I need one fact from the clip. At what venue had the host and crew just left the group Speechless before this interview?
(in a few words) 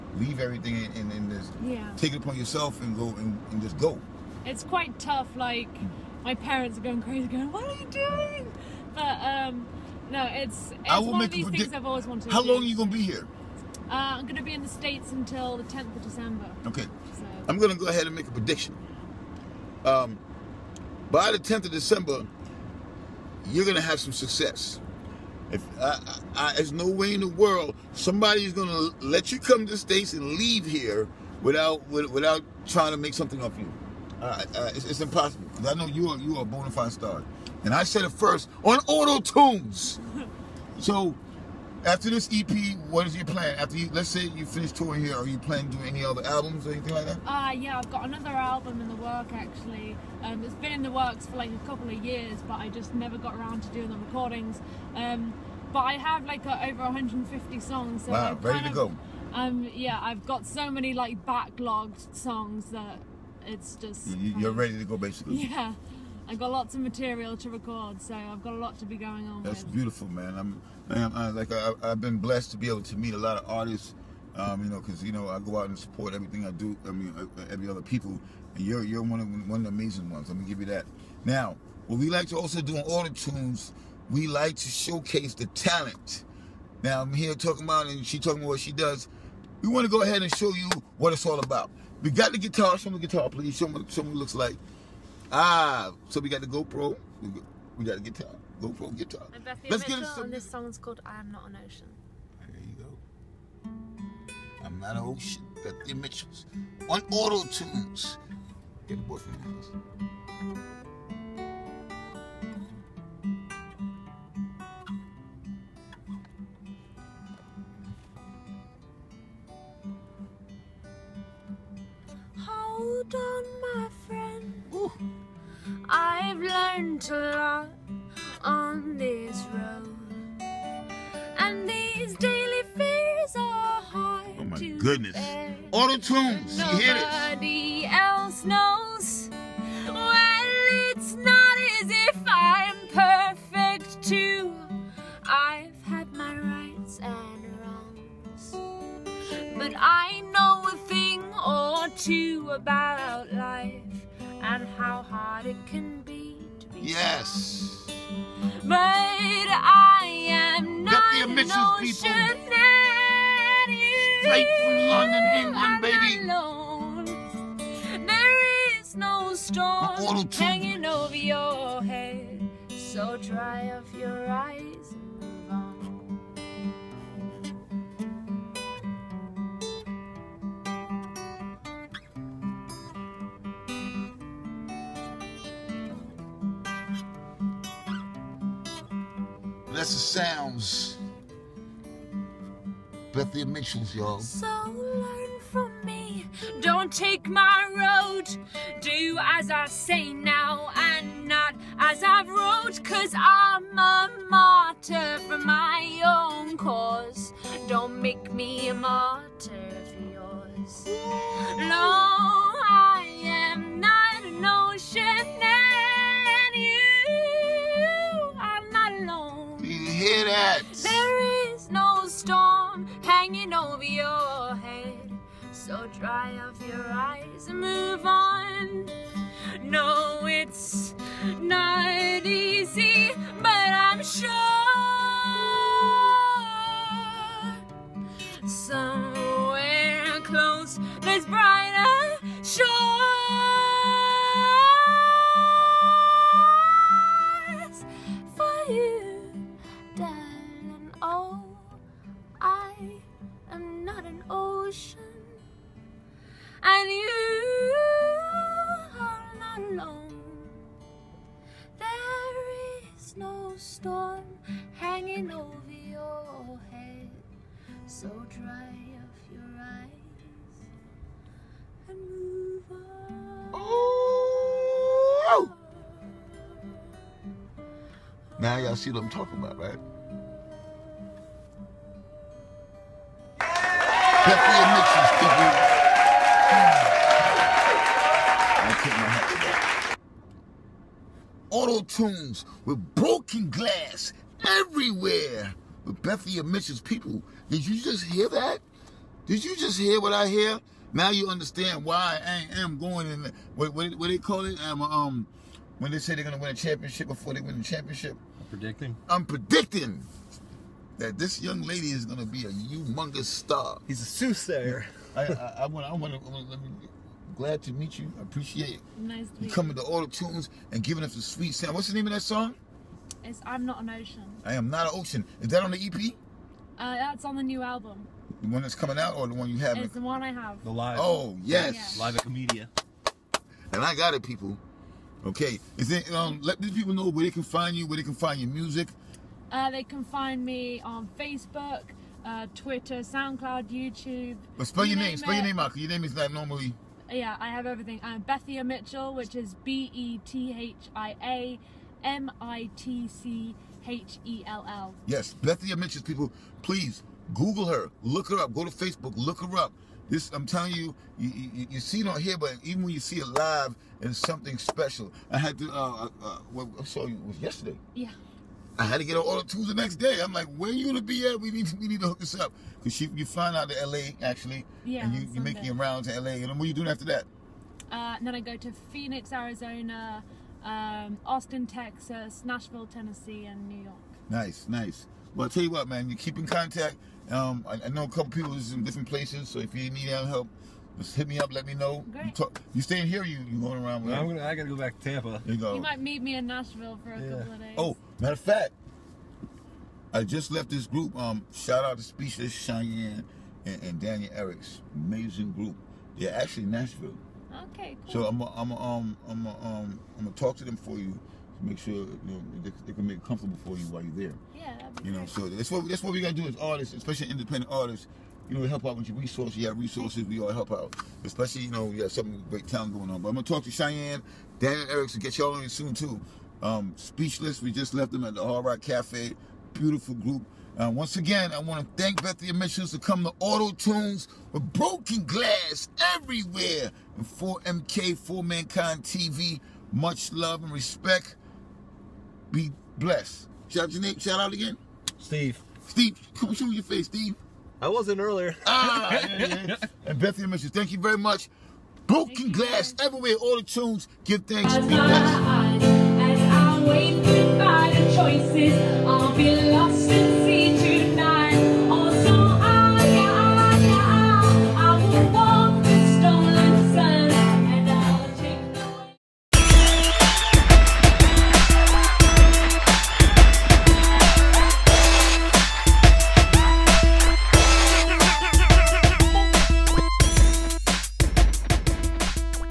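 Hard Rock Cafe.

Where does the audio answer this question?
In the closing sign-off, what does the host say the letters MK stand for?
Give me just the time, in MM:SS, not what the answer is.
07:18.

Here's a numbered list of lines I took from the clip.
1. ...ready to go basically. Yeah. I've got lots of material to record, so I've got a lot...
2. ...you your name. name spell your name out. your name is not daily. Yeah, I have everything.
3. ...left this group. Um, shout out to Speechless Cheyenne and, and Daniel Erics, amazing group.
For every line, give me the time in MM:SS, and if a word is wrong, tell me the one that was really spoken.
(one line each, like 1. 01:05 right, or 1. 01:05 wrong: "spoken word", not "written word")
1. 01:04 right
2. 05:44 wrong: "normally", not "daily"
3. 06:40 right.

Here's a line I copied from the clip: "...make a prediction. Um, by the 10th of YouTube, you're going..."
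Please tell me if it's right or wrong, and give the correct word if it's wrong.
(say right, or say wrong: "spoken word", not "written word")
wrong: "December", not "YouTube".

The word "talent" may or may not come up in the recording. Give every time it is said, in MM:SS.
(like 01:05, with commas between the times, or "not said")
01:25, 07:02.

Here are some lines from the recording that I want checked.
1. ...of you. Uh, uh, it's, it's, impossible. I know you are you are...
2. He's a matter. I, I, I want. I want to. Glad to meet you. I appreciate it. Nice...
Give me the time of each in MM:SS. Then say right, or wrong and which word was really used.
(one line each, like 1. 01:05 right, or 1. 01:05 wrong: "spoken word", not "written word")
1. 00:33 right
2. 05:13 wrong: "soothsayer", not "matter".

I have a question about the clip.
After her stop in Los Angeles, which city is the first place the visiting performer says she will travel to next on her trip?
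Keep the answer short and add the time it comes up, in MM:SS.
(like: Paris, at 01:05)
Phoenix, Arizona, at 06:18.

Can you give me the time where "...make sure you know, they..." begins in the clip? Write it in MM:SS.
06:51.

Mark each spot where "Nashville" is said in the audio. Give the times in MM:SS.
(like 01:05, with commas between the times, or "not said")
06:22, 06:36, 06:46.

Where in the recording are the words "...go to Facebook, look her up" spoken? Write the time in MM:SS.
05:58.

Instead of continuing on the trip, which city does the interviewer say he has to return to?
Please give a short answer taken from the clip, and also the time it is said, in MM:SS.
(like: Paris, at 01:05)
Tampa, at 06:35.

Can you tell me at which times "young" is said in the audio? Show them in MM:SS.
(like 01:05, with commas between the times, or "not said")
05:11.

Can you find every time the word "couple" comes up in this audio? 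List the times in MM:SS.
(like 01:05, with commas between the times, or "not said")
00:51, 06:28, 06:37.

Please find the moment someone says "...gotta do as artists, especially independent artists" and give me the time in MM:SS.
06:56.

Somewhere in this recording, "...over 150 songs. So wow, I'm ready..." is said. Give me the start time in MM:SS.
00:56.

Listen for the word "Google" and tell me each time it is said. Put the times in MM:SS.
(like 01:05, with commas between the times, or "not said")
05:57.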